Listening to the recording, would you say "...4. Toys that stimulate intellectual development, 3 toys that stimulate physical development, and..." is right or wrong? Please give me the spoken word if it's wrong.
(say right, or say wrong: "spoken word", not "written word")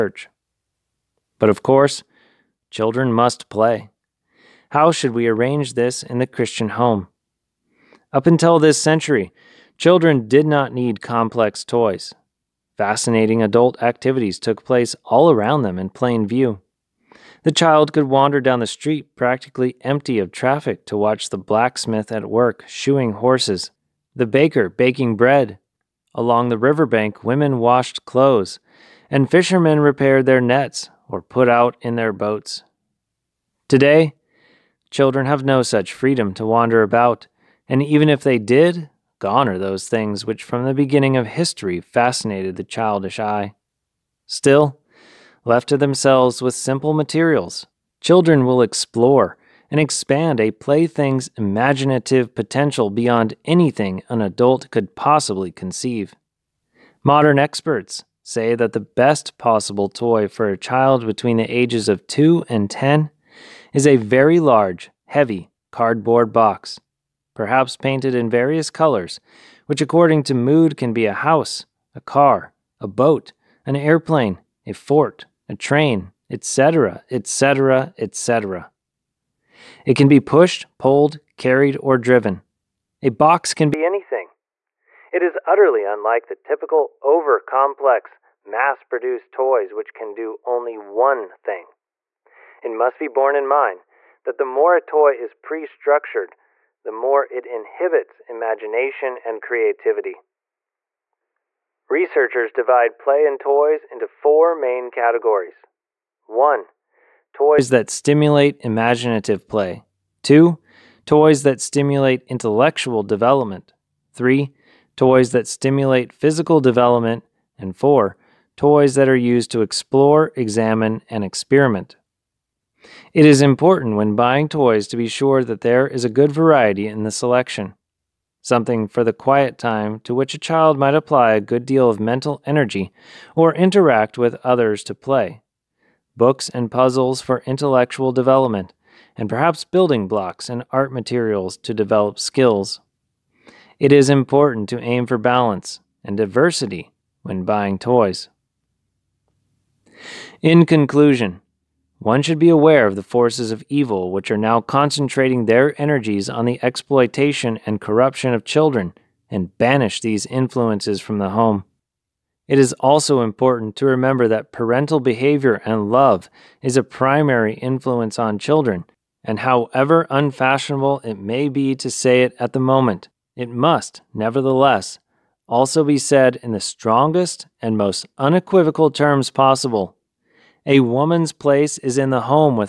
wrong: "2", not "4".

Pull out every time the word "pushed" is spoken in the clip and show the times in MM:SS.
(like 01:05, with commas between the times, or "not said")
01:20.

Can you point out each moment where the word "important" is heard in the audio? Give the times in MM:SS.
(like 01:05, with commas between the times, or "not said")
02:03, 02:24, 02:43.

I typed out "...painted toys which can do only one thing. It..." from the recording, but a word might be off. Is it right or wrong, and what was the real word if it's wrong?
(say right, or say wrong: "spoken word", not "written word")
wrong: "produced", not "painted".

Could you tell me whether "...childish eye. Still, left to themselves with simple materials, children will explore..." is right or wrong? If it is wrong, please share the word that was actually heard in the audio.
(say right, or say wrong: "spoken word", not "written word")
right.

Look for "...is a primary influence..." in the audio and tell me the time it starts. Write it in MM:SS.
02:46.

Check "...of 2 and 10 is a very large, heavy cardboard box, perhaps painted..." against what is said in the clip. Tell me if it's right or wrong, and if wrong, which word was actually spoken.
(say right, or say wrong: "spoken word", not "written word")
right.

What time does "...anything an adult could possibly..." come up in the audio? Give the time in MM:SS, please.
00:53.